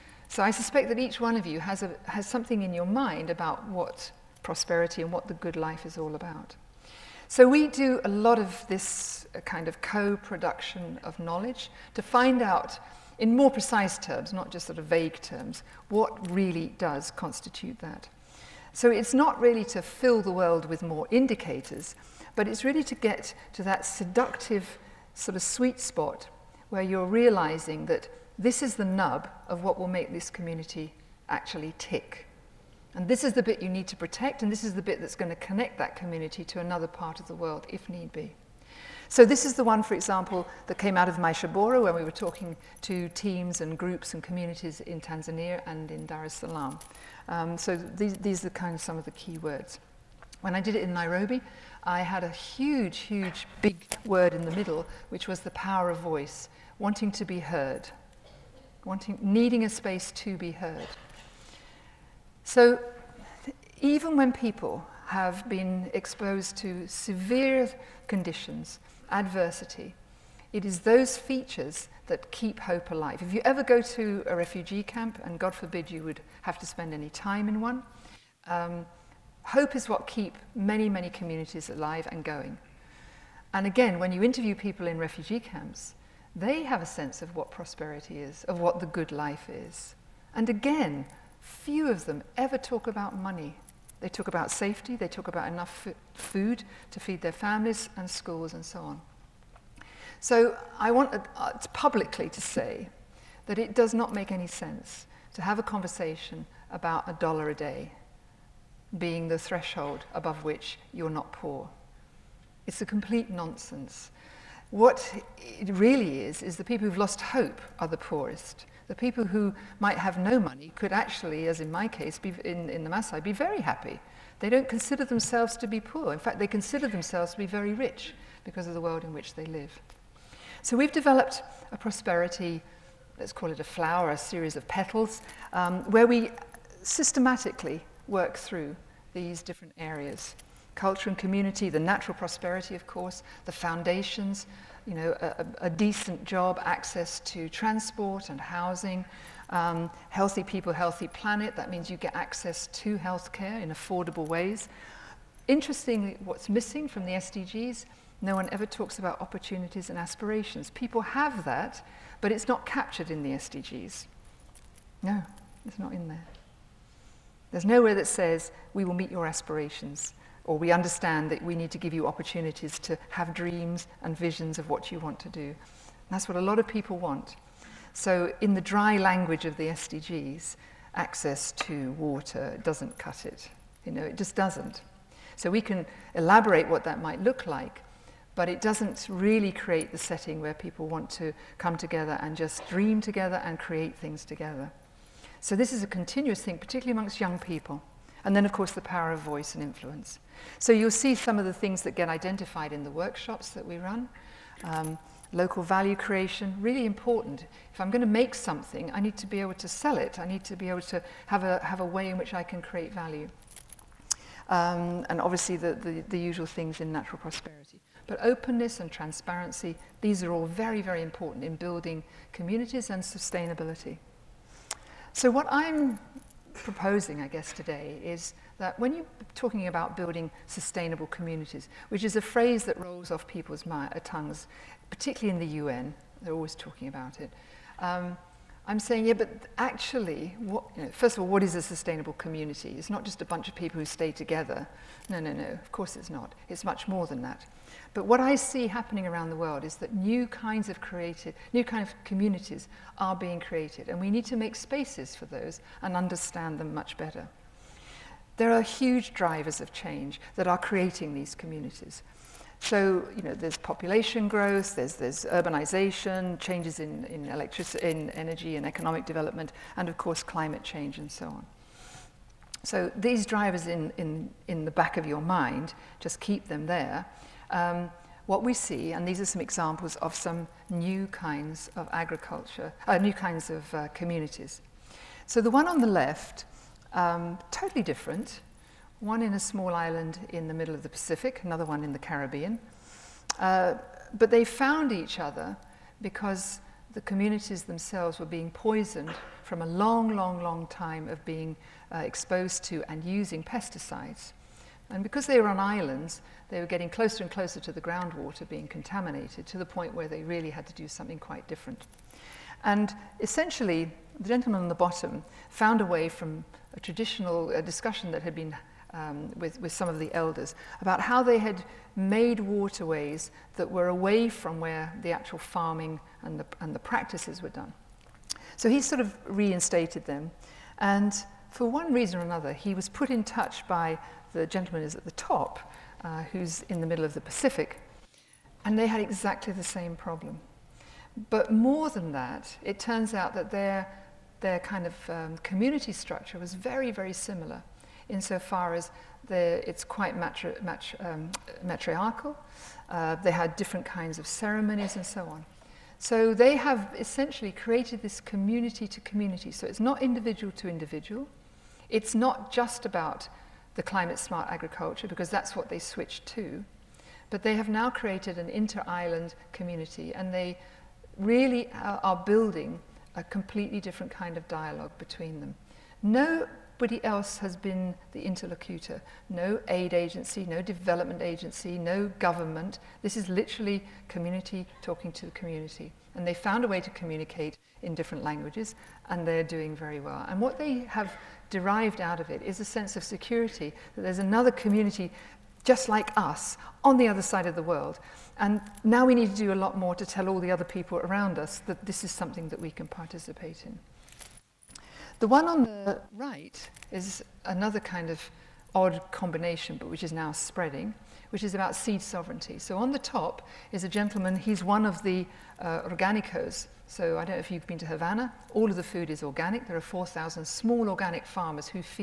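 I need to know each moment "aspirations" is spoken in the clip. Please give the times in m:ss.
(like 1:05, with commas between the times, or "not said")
2:39, 2:49.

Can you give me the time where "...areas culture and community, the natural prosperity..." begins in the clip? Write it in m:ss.
2:19.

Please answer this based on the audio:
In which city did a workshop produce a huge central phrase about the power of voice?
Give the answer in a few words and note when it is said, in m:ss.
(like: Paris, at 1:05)
Nairobi, at 0:50.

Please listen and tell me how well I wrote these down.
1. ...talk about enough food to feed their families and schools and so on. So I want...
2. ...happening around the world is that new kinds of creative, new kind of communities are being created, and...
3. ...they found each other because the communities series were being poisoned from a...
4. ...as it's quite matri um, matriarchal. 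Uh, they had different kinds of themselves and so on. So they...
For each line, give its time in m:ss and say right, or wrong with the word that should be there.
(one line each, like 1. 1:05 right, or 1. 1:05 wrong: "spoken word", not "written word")
1. 1:35 right
2. 4:08 right
3. 4:54 wrong: "themselves", not "series"
4. 5:48 wrong: "ceremonies", not "themselves".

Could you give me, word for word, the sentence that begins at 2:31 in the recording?
That means you get access to healthcare in affordable ways.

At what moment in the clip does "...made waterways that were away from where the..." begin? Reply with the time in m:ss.
5:21.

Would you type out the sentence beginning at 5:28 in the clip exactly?
So he sort of reinstated them.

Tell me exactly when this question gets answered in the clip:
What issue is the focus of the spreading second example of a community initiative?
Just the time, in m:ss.
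6:51.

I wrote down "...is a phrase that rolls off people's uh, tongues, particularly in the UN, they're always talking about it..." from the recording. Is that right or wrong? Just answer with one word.
right.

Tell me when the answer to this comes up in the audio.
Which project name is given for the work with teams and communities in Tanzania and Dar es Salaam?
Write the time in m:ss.
0:41.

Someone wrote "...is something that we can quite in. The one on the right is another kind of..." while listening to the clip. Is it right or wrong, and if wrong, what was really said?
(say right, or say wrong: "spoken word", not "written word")
wrong: "participate", not "quite".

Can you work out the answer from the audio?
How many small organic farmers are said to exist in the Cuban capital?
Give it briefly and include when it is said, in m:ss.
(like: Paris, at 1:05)
4,000, at 6:59.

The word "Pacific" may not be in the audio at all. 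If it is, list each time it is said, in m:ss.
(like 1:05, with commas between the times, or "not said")
4:50, 5:37.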